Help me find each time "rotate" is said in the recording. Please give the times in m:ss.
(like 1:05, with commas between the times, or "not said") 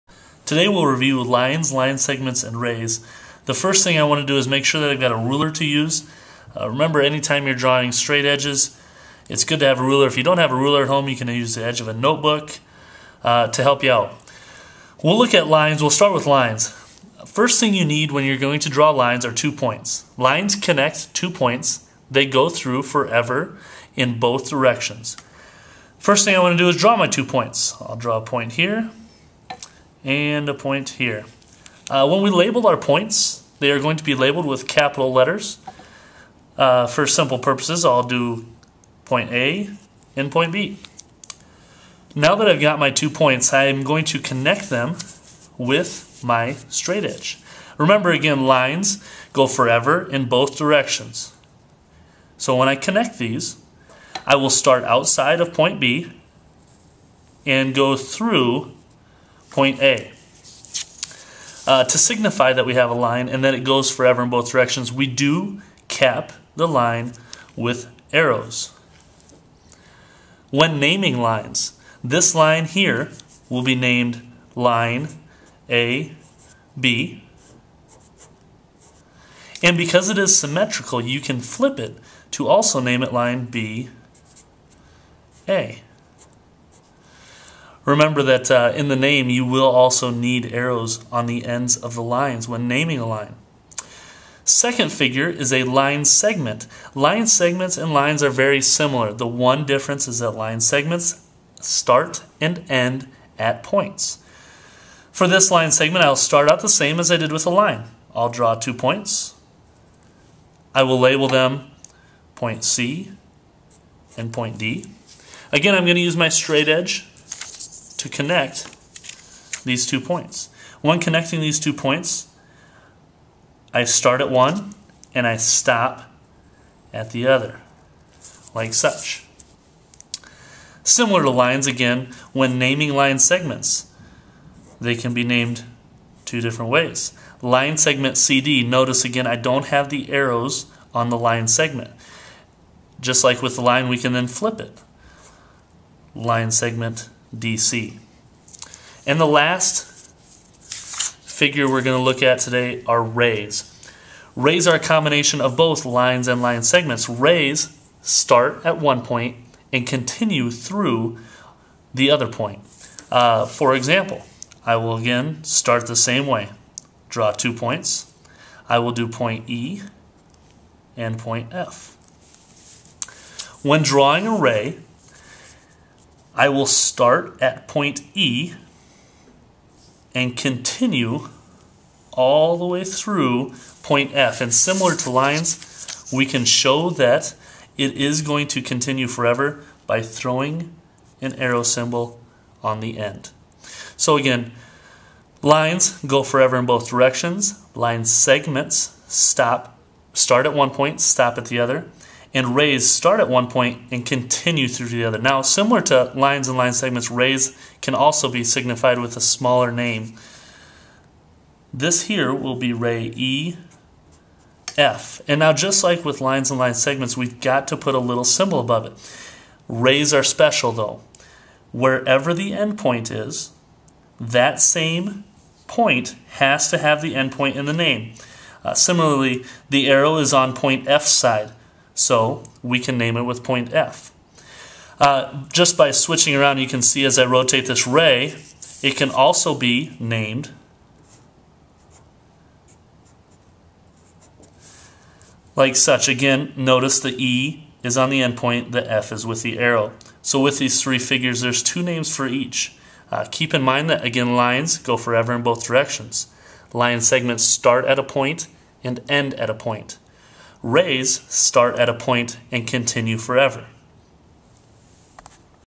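3:57.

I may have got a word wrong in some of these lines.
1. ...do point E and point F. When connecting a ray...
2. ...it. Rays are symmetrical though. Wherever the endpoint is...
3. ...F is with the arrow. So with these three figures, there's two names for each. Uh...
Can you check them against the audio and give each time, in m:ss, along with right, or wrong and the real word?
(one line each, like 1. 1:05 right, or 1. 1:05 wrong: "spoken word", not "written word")
1. 2:48 wrong: "drawing", not "connecting"
2. 3:38 wrong: "special", not "symmetrical"
3. 4:08 right.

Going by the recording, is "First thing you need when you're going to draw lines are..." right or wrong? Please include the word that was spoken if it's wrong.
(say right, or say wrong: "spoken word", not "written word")
right.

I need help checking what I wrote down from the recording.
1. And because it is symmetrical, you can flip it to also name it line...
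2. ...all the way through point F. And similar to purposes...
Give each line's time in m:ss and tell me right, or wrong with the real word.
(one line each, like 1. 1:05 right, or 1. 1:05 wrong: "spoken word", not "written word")
1. 1:19 right
2. 3:02 wrong: "lines", not "purposes".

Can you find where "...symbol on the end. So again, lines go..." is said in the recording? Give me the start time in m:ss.
3:11.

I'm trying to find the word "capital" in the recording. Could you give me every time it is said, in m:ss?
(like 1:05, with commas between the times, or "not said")
0:34.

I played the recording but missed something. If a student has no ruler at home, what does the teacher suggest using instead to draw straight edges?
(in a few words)
The edge of a notebook.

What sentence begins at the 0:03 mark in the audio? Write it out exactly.
The first thing I want to do is make sure that I've got a ruler to use.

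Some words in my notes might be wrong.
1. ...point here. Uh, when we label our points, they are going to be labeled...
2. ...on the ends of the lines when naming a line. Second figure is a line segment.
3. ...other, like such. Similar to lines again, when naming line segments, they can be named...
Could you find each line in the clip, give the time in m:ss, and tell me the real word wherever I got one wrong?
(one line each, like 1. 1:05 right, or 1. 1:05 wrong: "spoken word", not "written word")
1. 0:30 right
2. 1:31 right
3. 2:07 right.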